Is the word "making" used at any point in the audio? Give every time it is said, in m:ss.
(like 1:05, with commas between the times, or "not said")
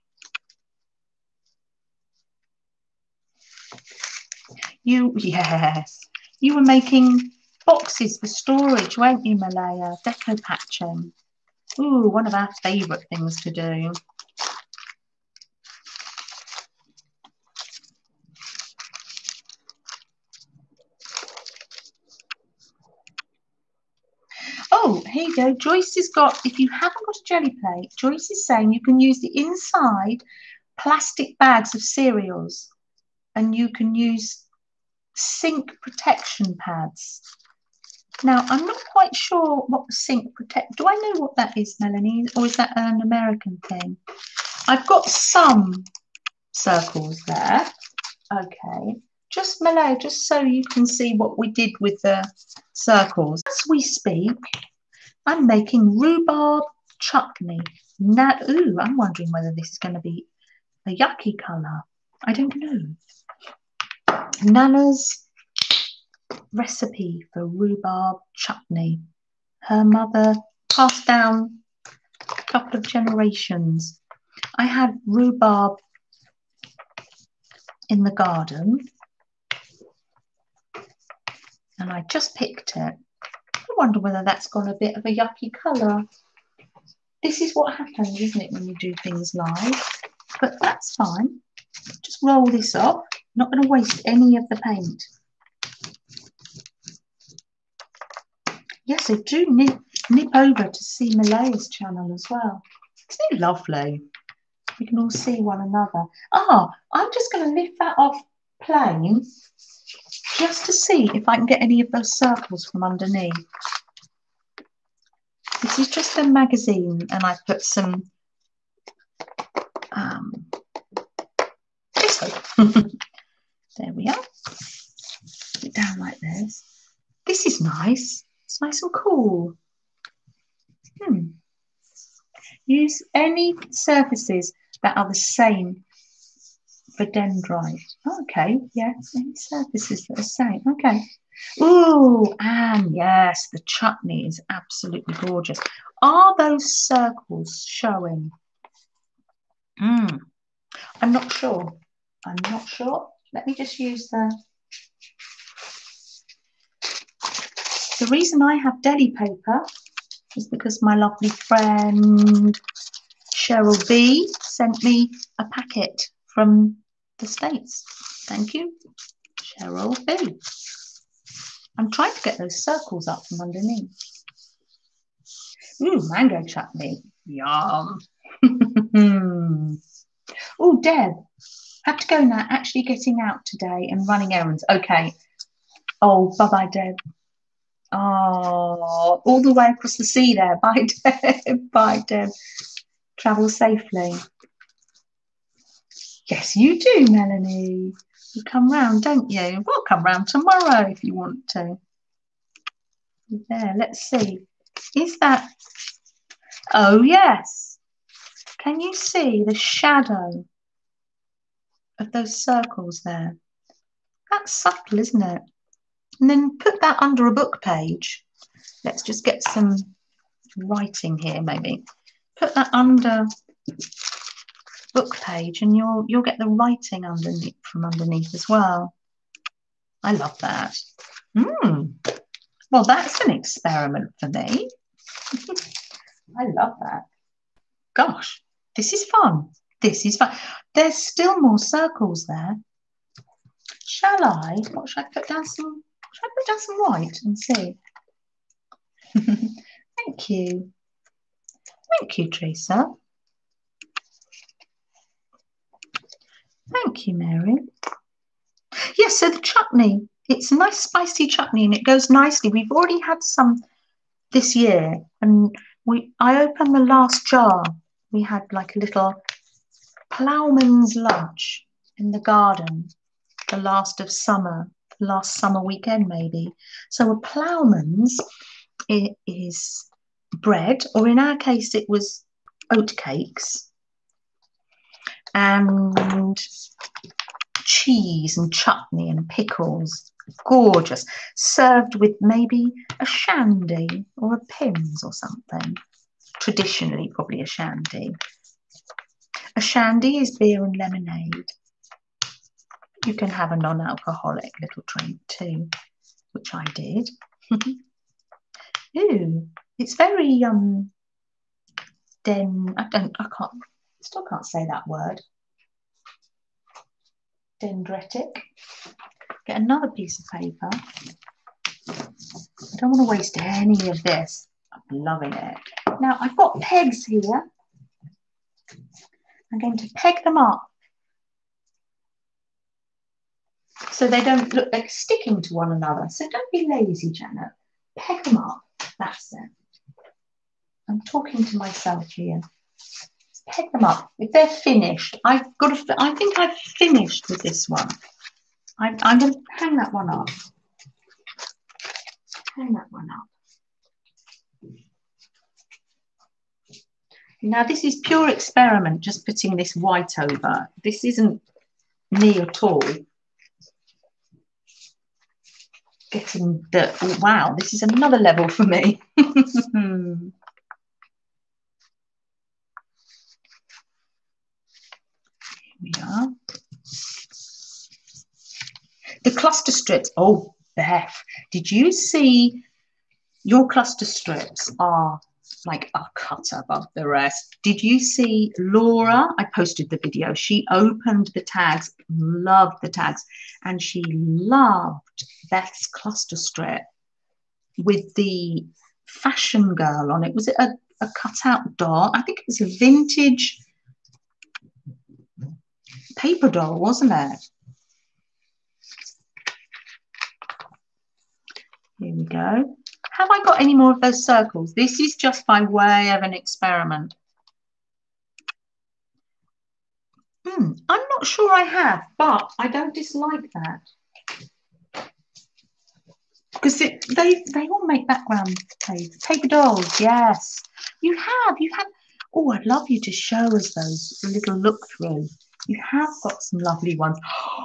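0:06, 0:55.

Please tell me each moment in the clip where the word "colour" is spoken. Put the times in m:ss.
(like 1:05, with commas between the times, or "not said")
1:01, 1:25.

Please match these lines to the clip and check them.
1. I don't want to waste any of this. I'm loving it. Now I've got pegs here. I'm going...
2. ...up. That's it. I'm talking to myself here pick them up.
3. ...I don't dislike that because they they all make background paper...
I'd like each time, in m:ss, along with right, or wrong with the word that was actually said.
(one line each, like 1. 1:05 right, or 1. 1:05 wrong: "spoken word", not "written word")
1. 5:21 right
2. 5:38 right
3. 7:02 right.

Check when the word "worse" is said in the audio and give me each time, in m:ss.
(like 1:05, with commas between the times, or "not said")
not said.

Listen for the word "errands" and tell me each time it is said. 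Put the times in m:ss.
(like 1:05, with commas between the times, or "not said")
3:04.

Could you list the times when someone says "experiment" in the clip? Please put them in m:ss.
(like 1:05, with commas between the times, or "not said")
3:53, 5:58, 6:56.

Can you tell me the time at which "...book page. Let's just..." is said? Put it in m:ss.
3:37.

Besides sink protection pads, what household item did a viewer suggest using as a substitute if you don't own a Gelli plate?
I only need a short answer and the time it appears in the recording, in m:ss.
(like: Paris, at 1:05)
Inside plastic bags of cereals, at 0:29.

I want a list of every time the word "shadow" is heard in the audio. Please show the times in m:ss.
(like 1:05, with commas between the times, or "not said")
3:29.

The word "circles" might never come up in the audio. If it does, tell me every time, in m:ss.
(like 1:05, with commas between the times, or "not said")
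0:46, 0:52, 1:52, 2:26, 2:52, 3:32, 4:01, 6:54.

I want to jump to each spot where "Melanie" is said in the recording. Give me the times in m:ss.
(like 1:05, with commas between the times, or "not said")
0:41, 3:17.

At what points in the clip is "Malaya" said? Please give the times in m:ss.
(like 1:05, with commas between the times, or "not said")
0:09, 1:41.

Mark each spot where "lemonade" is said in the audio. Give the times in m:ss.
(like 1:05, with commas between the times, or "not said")
5:00.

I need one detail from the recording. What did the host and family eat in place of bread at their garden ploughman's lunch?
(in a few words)
Oat cakes.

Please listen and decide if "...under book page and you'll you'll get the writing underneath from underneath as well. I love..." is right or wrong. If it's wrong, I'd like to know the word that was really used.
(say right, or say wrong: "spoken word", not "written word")
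right.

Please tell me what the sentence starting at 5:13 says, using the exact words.
I can't Still can't say that word.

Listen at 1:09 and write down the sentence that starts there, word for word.
Her mother passed down a couple of generations.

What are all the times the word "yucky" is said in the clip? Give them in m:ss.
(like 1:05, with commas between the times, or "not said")
1:00, 1:25.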